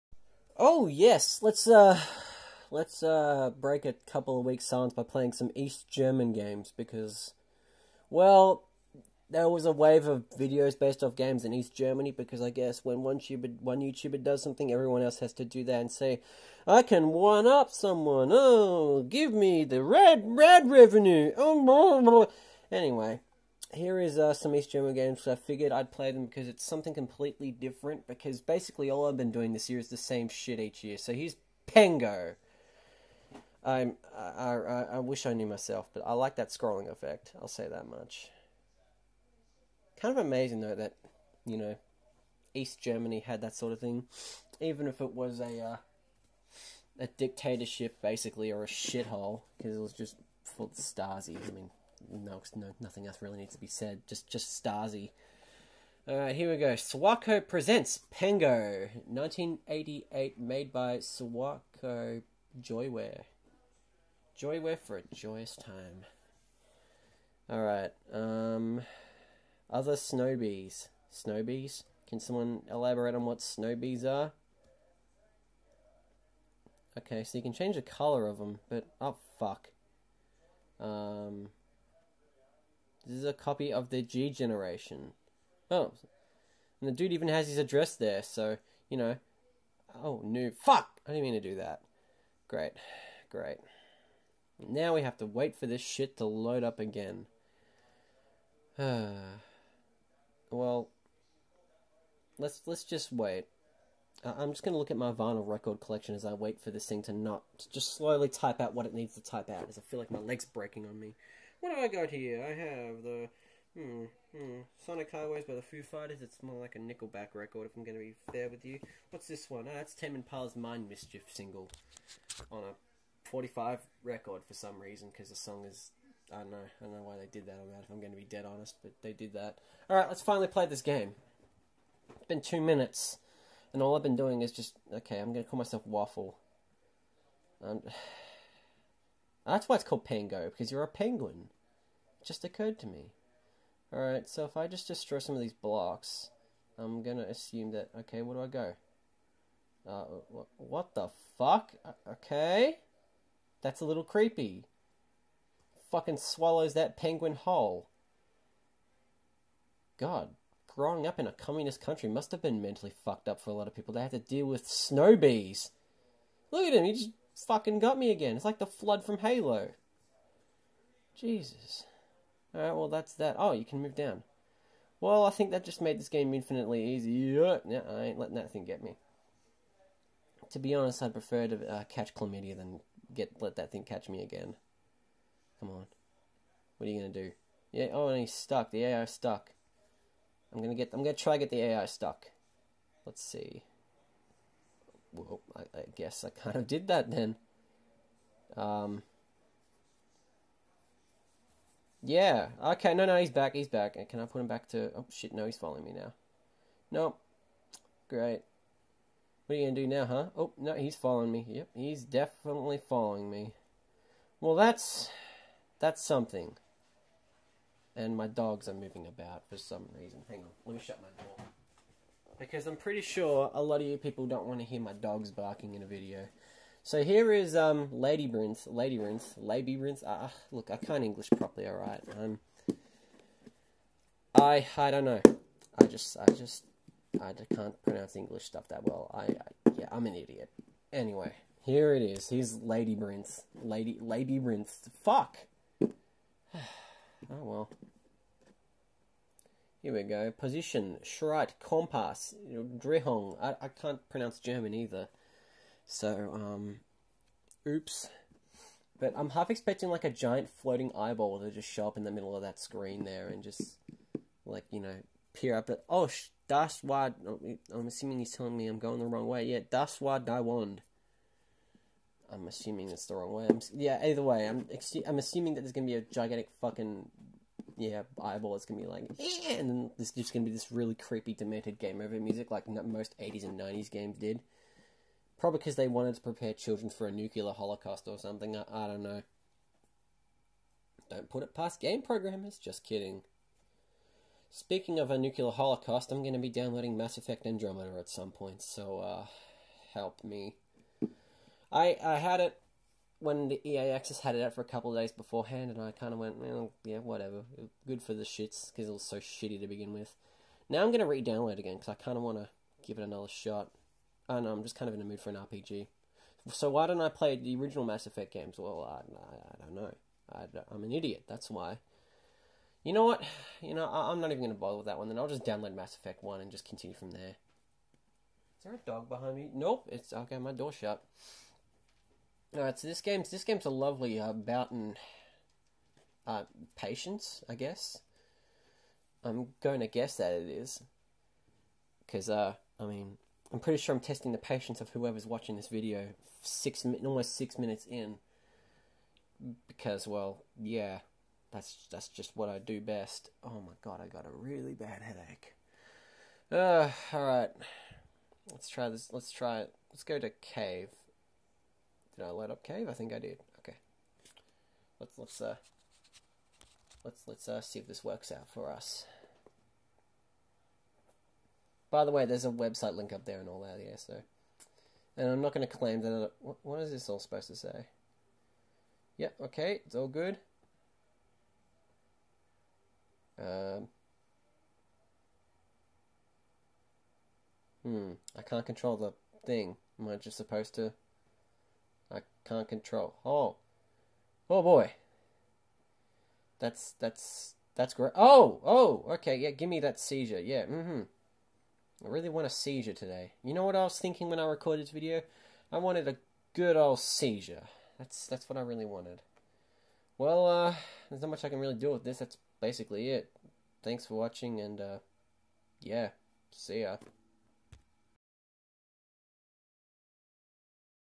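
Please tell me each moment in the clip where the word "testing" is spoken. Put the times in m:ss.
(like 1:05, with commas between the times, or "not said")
5:44.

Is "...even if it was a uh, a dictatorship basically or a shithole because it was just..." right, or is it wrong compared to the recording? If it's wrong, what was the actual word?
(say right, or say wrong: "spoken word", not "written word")
right.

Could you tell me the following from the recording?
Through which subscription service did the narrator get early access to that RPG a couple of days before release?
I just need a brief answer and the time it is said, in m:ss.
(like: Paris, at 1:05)
EA Access, at 5:03.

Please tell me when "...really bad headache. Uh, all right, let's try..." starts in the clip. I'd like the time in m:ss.
5:54.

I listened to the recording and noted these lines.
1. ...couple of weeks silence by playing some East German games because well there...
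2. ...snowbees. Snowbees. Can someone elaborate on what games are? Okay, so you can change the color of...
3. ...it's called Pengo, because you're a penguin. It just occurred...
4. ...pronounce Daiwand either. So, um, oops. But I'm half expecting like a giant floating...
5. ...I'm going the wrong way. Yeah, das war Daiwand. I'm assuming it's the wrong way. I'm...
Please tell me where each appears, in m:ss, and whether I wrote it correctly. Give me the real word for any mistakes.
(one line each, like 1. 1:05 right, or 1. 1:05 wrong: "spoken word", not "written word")
1. 0:04 right
2. 1:09 wrong: "snowbees", not "games"
3. 2:19 right
4. 4:14 wrong: "German", not "Daiwand"
5. 4:28 right.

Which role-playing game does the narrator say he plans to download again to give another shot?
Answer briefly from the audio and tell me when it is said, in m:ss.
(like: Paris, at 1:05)
Mass Effect Andromeda, at 4:56.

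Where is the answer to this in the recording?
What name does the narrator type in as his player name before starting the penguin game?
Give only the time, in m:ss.
2:15.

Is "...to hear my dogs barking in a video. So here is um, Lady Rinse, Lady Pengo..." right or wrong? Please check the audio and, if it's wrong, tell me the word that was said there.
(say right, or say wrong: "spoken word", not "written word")
wrong: "Rinse", not "Pengo".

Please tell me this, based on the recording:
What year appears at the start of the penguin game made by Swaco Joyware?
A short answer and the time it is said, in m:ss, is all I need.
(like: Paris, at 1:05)
1988, at 0:59.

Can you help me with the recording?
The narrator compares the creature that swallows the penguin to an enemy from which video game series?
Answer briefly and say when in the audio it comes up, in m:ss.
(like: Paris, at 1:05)
Halo, at 2:49.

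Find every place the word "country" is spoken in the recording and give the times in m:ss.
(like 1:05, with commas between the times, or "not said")
2:41.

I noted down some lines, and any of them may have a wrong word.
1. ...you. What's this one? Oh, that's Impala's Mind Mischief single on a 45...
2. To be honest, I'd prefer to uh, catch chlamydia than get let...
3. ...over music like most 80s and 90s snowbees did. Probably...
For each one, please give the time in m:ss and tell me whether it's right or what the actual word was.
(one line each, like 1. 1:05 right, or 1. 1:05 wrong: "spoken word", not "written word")
1. 1:58 right
2. 3:00 right
3. 4:41 wrong: "games", not "snowbees".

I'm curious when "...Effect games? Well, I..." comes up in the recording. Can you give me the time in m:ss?
5:18.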